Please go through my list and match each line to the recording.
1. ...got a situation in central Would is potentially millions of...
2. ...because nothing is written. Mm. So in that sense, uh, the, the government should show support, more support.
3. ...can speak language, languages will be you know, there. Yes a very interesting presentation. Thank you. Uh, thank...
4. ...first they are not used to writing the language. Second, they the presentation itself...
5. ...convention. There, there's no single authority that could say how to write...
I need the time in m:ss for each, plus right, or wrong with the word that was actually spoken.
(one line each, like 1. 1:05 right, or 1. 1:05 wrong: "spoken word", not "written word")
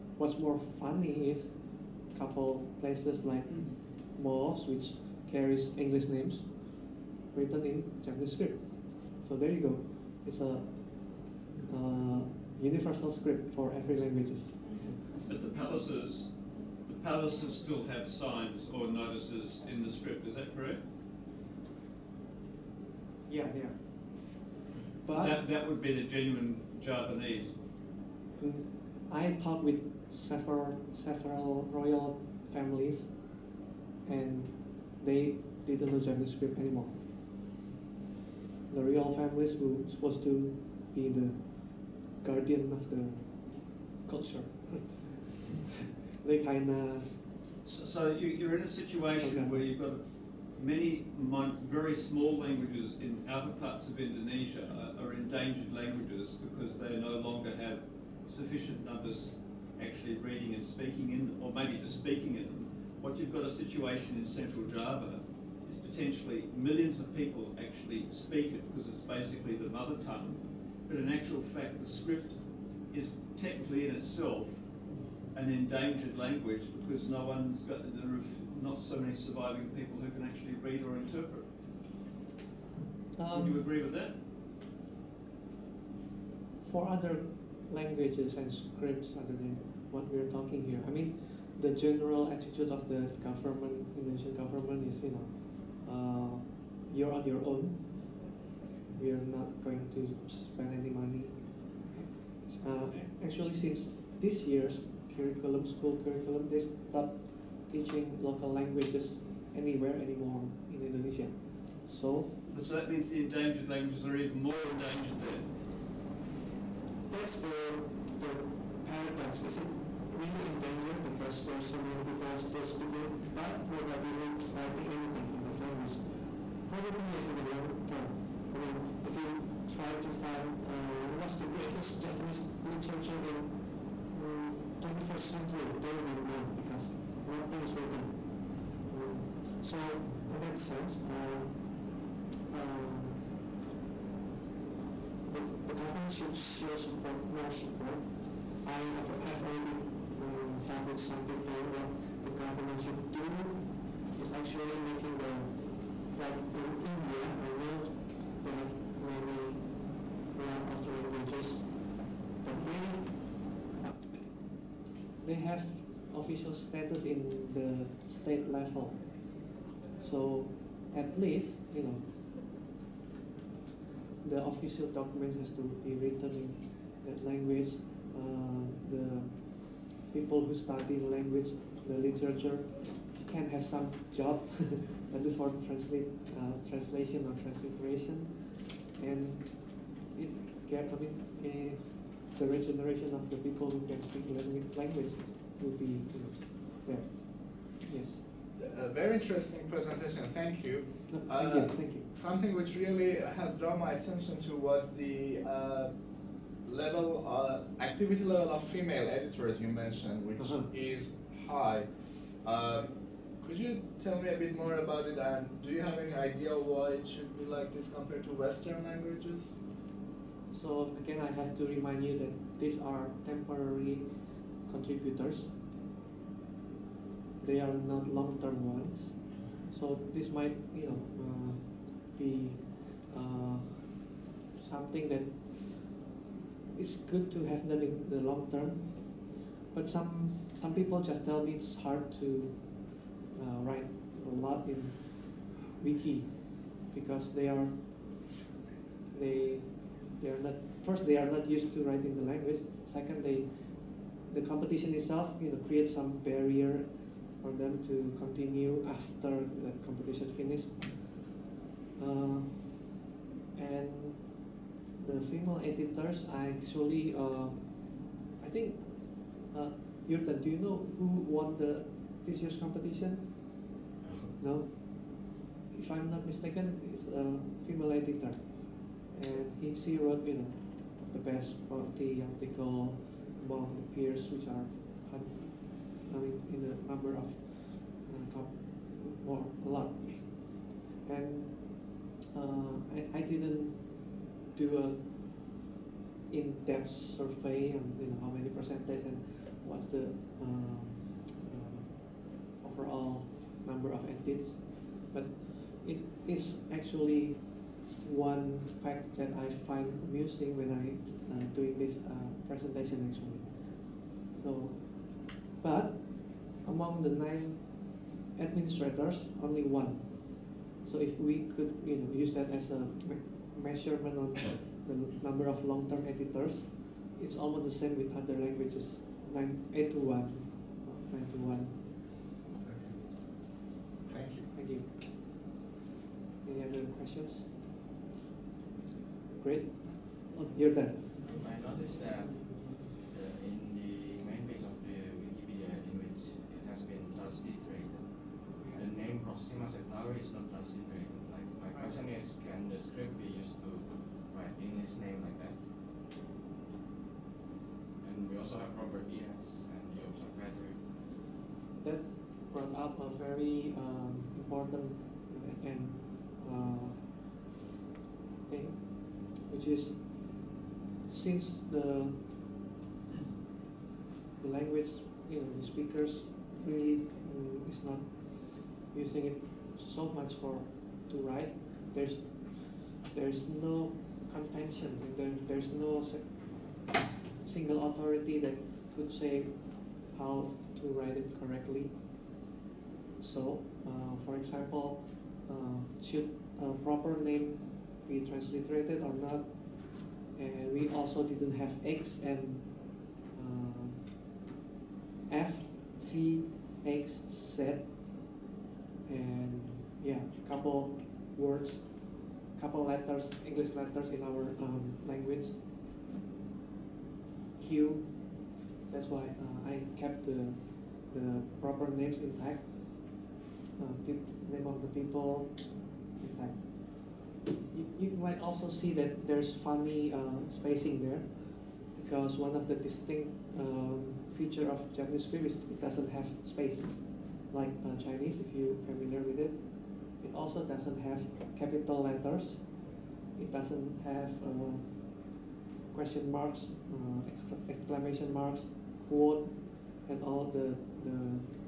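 1. 1:03 wrong: "Java", not "Would"
2. 2:16 right
3. 3:13 right
4. 4:10 wrong: "competition", not "presentation"
5. 6:24 right.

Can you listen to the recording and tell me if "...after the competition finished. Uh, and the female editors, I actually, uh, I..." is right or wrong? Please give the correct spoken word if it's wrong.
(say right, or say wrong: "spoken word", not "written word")
right.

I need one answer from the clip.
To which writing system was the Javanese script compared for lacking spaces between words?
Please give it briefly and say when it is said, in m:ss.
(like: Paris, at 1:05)
Chinese, at 7:18.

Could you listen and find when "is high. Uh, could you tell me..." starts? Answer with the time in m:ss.
3:30.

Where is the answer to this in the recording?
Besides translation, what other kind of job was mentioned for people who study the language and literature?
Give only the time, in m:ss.
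3:07.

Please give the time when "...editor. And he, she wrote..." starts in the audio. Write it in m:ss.
4:37.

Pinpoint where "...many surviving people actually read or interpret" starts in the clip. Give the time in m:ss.
1:18.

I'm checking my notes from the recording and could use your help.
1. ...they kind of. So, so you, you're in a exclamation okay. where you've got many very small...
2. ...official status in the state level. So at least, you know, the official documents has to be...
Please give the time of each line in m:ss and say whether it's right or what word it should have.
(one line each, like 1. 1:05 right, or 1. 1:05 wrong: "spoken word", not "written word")
1. 0:46 wrong: "situation", not "exclamation"
2. 2:46 right.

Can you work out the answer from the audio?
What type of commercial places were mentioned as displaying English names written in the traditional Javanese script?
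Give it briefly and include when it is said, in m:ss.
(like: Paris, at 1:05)
Malls, at 0:04.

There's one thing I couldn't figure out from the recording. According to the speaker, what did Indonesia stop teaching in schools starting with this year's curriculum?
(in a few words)
Local languages.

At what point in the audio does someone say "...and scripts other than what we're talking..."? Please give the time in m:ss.
1:28.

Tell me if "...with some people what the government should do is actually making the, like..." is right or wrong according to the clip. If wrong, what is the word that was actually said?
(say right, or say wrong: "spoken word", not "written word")
right.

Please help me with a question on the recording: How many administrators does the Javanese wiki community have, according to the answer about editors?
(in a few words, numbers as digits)
9.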